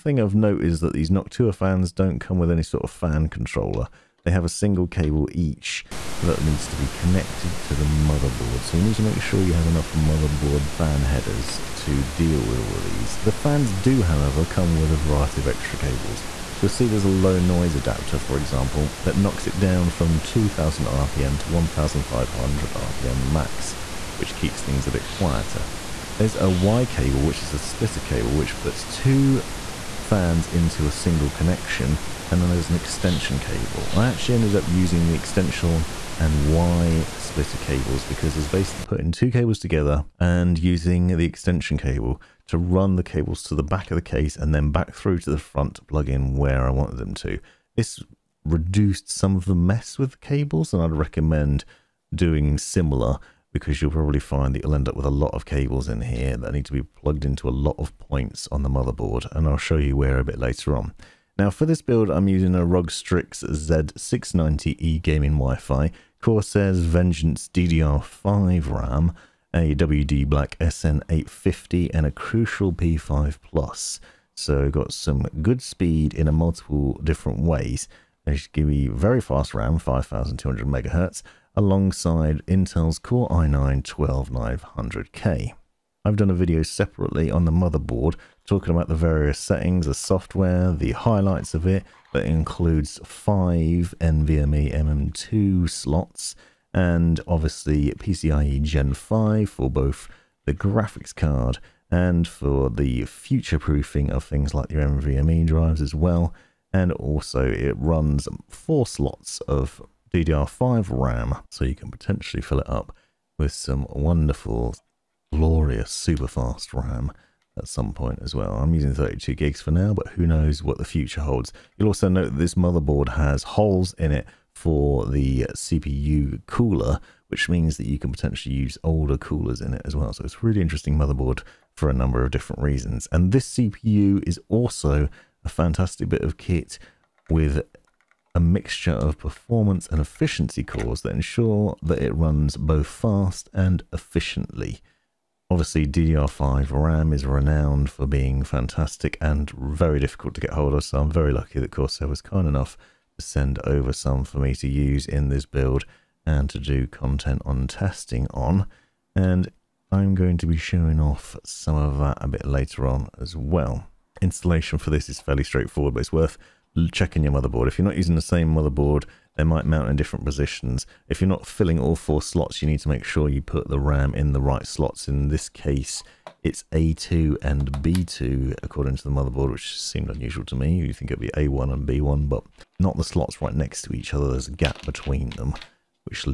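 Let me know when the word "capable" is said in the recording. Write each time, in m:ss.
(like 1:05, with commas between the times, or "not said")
not said.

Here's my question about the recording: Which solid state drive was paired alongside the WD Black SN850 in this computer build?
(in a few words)
Crucial P5 Plus.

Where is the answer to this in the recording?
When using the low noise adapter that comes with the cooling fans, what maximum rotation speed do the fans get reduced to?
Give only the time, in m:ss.
0:21.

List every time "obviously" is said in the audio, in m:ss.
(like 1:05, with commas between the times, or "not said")
1:37, 2:25.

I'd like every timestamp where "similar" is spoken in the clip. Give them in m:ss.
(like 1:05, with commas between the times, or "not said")
0:52.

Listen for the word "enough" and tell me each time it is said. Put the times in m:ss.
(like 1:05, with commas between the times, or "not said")
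0:09, 2:32.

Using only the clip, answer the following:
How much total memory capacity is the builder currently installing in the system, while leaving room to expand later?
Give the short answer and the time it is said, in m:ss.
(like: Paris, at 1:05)
32 gigs, at 1:58.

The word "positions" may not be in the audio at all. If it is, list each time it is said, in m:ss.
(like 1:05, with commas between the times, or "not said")
2:50.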